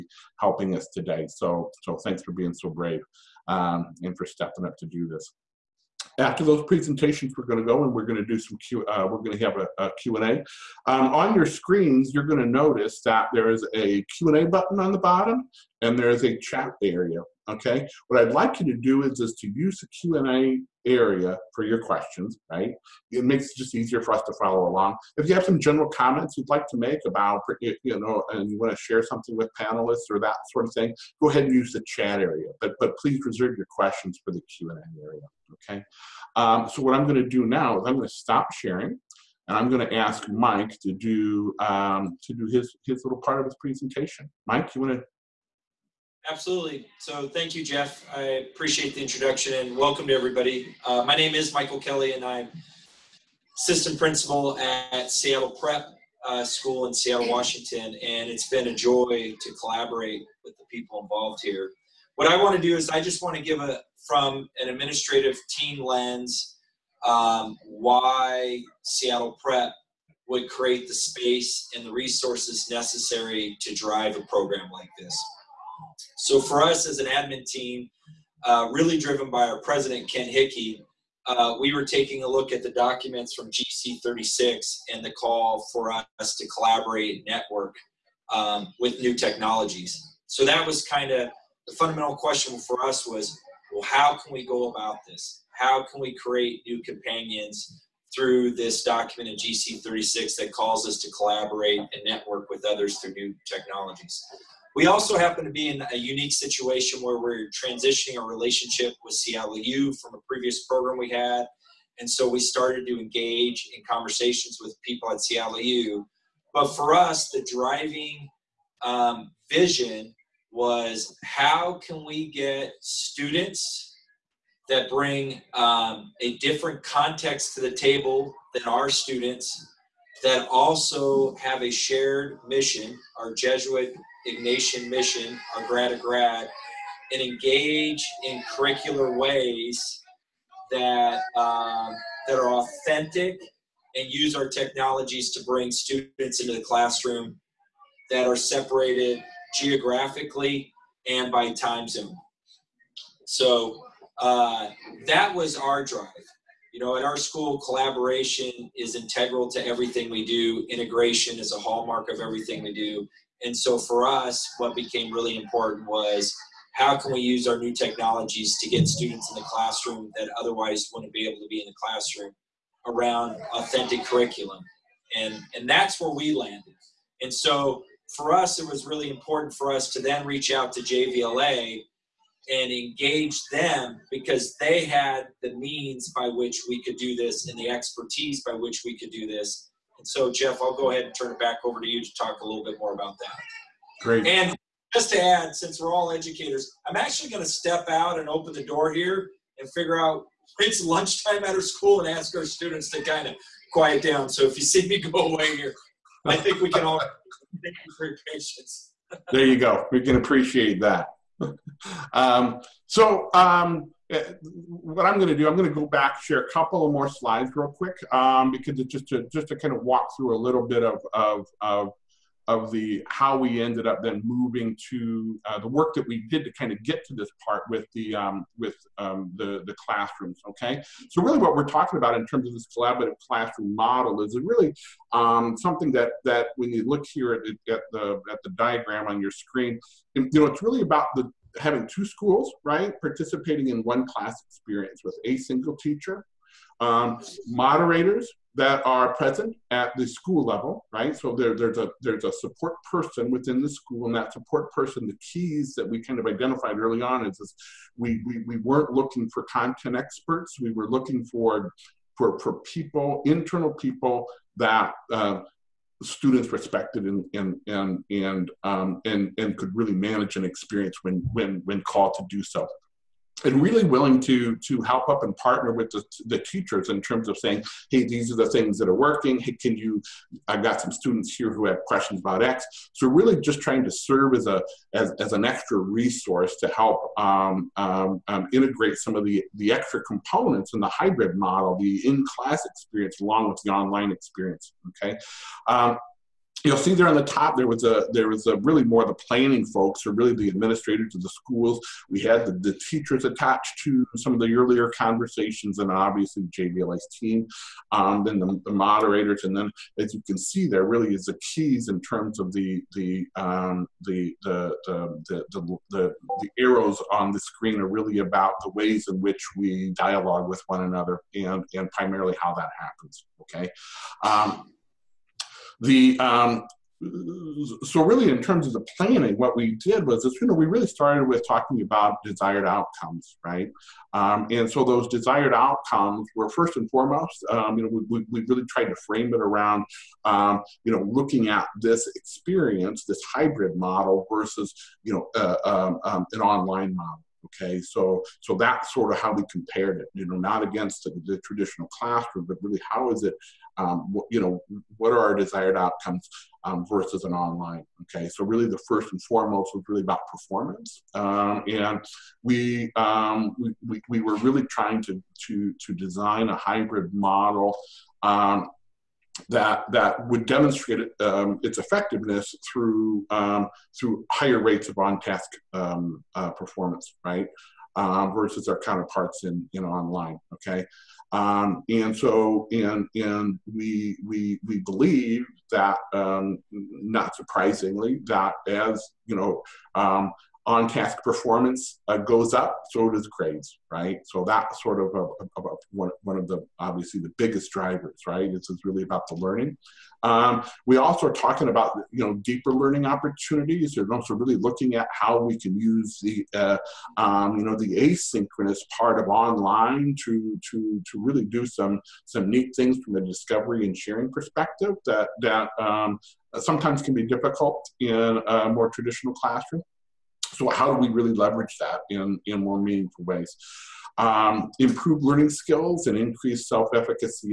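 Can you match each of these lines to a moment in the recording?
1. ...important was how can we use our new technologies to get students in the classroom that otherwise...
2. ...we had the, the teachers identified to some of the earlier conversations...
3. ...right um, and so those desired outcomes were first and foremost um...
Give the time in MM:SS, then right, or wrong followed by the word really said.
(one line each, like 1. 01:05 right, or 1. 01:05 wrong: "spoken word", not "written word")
1. 02:45 right
2. 05:02 wrong: "attached", not "identified"
3. 05:33 right.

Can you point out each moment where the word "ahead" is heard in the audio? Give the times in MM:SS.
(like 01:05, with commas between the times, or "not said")
00:31, 03:10.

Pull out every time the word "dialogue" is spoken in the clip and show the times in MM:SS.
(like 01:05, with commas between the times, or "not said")
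05:19.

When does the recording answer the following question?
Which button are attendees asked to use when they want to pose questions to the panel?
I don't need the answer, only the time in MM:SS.
00:14.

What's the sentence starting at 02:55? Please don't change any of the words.
And, and that's where we landed.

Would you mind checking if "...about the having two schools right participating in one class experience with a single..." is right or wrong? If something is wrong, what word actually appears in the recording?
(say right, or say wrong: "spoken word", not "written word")
right.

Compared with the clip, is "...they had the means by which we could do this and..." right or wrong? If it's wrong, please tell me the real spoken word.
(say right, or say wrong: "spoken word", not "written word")
right.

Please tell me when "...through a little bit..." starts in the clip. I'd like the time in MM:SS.
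03:40.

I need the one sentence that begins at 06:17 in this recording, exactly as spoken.
Uh, versus our counterparts in in online.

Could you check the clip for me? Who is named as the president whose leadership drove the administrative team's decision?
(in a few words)
Ken Hickey.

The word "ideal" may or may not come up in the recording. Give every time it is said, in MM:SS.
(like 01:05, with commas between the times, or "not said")
not said.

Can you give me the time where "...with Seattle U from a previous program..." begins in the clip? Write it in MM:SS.
01:49.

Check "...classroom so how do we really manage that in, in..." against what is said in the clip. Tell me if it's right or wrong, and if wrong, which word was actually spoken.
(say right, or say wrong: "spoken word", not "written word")
wrong: "leverage", not "manage".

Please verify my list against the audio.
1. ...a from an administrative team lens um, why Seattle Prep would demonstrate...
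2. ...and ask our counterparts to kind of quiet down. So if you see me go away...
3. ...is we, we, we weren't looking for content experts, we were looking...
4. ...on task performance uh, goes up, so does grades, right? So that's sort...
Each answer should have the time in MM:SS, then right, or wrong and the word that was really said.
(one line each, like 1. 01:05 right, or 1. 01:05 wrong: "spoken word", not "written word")
1. 01:03 wrong: "create", not "demonstrate"
2. 03:22 wrong: "students", not "counterparts"
3. 04:17 right
4. 06:30 right.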